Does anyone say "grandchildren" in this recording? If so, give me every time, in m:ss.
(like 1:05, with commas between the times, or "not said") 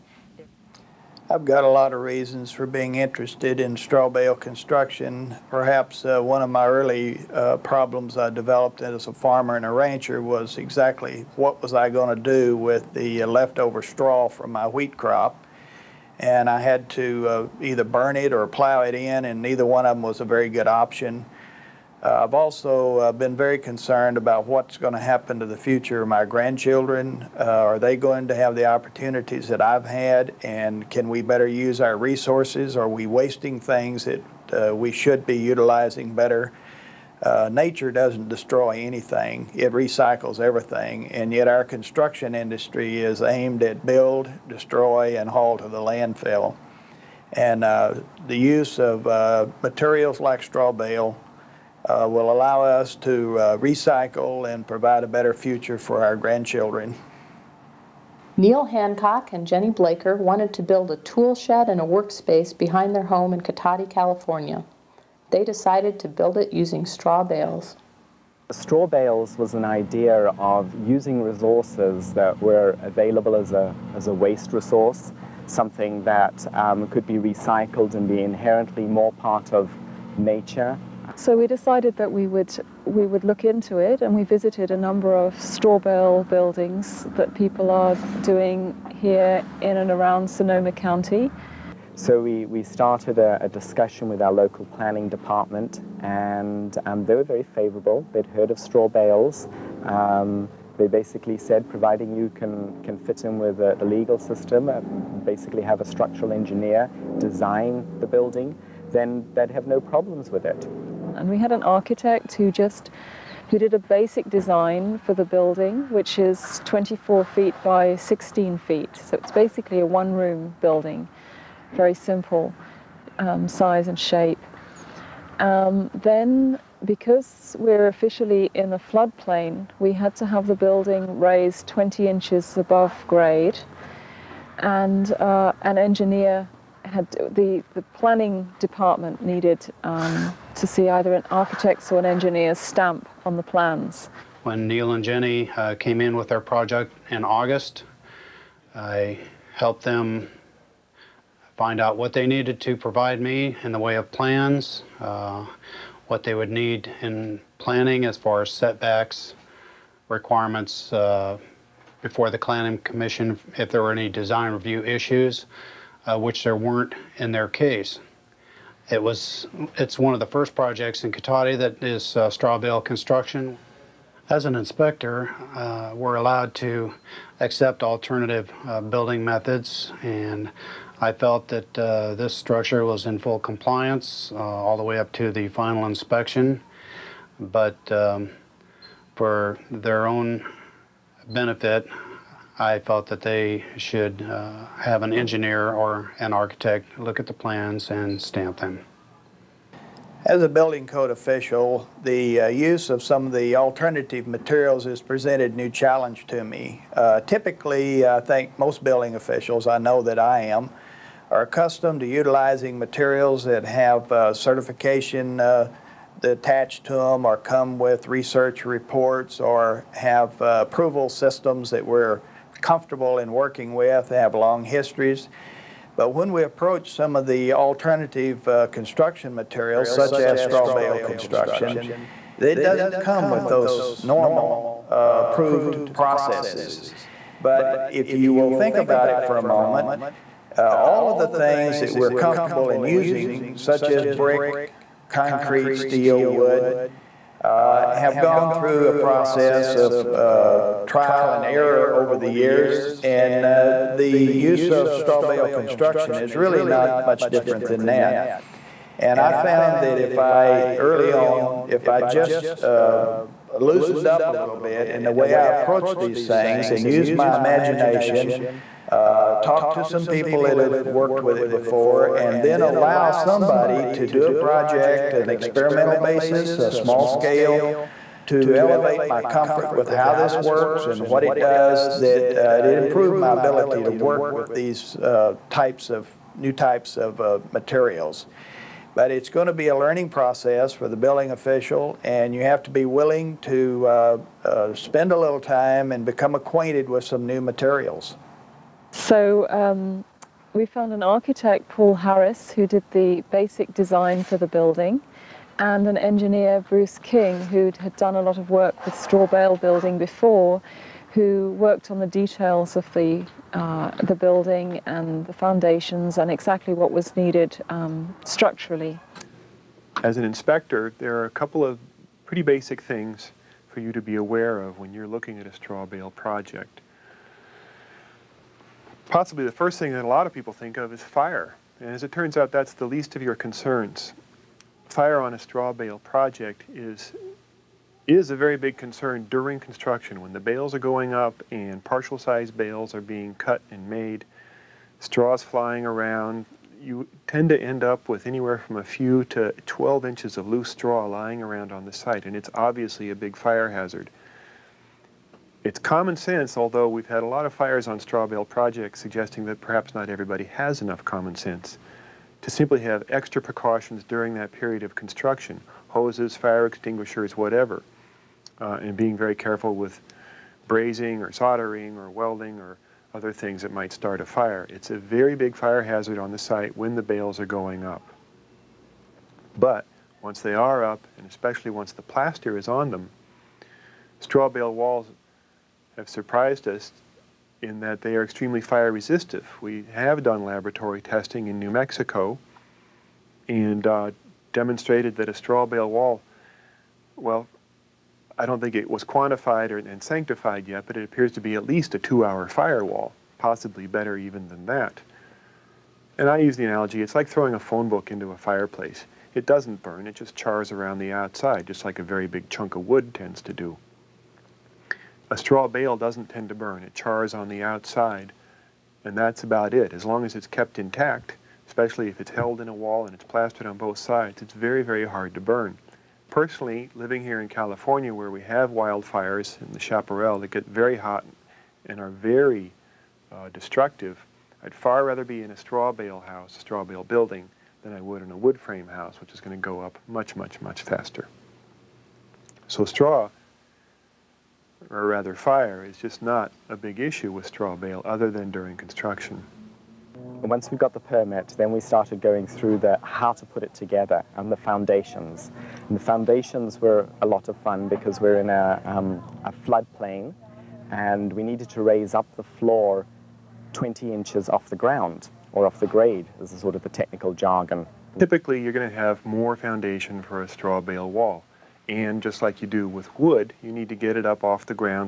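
0:26, 0:56.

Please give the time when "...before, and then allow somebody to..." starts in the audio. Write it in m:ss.
4:31.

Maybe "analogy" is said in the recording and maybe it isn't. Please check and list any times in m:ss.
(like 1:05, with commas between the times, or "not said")
6:46.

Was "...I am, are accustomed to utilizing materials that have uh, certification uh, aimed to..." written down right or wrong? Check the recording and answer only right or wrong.
wrong.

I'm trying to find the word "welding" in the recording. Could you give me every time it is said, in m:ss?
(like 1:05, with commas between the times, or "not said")
6:12.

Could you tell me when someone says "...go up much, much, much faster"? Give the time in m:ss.
7:19.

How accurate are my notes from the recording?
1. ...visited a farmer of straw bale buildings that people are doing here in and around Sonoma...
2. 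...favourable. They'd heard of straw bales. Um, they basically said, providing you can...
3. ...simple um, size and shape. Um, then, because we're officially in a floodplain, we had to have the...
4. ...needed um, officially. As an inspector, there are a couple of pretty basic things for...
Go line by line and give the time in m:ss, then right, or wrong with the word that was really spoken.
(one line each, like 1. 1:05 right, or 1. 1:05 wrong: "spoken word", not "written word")
1. 1:24 wrong: "number", not "farmer"
2. 1:37 right
3. 2:01 right
4. 5:17 wrong: "structurally", not "officially".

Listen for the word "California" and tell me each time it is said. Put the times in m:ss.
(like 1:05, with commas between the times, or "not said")
1:03, 7:07.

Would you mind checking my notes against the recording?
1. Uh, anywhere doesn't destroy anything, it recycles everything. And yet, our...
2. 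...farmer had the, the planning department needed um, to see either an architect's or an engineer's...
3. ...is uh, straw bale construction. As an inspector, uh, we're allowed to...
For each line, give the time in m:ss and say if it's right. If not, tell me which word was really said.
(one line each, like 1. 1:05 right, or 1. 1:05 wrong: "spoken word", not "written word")
1. 0:37 wrong: "nature", not "anywhere"
2. 2:15 wrong: "engineer", not "farmer"
3. 2:51 right.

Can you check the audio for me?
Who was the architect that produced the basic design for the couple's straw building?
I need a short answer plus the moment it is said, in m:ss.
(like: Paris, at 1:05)
Paul Harris, at 5:01.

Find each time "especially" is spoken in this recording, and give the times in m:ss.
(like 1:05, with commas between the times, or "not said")
6:21, 7:01.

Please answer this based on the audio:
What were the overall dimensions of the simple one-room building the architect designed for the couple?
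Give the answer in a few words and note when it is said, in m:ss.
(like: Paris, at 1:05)
24 feet by 16 feet, at 1:56.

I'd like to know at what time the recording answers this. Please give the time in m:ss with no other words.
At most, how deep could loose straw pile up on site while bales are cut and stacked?
5:49.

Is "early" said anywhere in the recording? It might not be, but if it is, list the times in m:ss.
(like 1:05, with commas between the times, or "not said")
0:06, 4:20.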